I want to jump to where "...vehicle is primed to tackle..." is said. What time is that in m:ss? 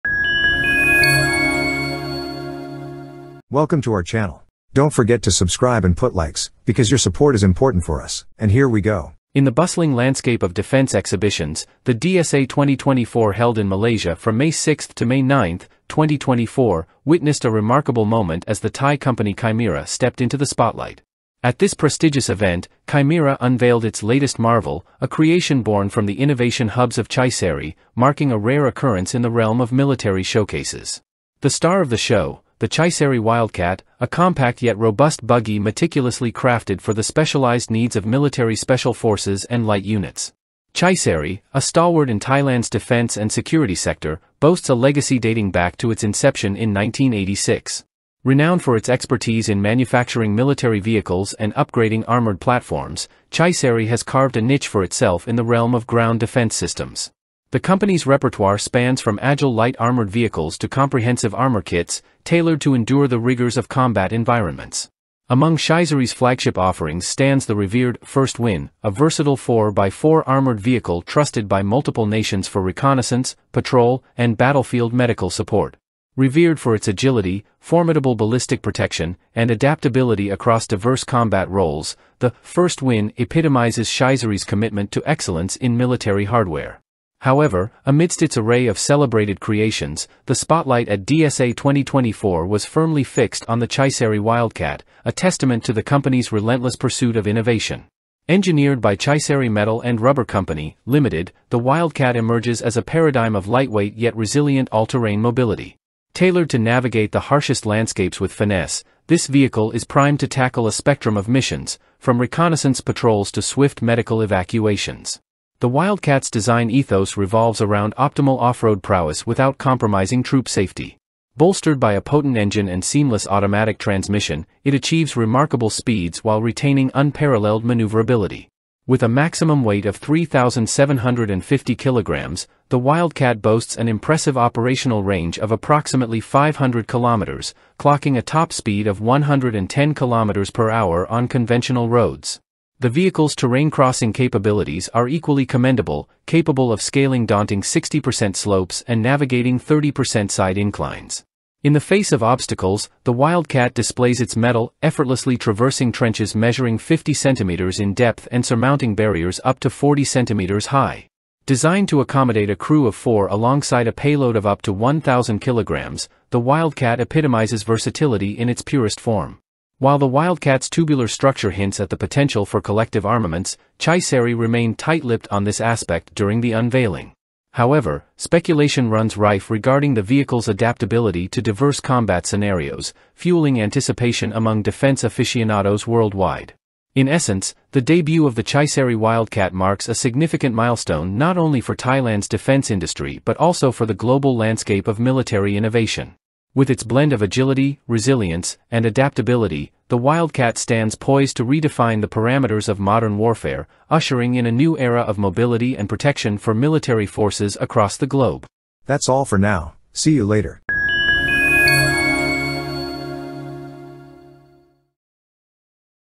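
1:49.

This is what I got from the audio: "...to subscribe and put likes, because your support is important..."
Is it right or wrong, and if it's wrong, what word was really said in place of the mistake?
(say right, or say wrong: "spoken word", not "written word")
right.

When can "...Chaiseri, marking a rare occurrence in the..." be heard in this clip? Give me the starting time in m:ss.
0:27.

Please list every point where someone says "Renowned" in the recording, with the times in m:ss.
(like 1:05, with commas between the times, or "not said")
0:48.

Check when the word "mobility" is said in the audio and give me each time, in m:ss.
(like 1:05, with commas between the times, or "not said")
1:45, 3:25.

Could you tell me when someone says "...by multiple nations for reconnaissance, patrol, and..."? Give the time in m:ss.
1:11.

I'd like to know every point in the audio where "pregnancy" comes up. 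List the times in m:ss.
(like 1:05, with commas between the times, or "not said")
not said.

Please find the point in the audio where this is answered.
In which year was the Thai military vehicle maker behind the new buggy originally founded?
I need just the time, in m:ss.
0:46.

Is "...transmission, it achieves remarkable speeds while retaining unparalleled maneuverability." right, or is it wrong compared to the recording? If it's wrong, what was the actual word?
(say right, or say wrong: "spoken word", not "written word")
right.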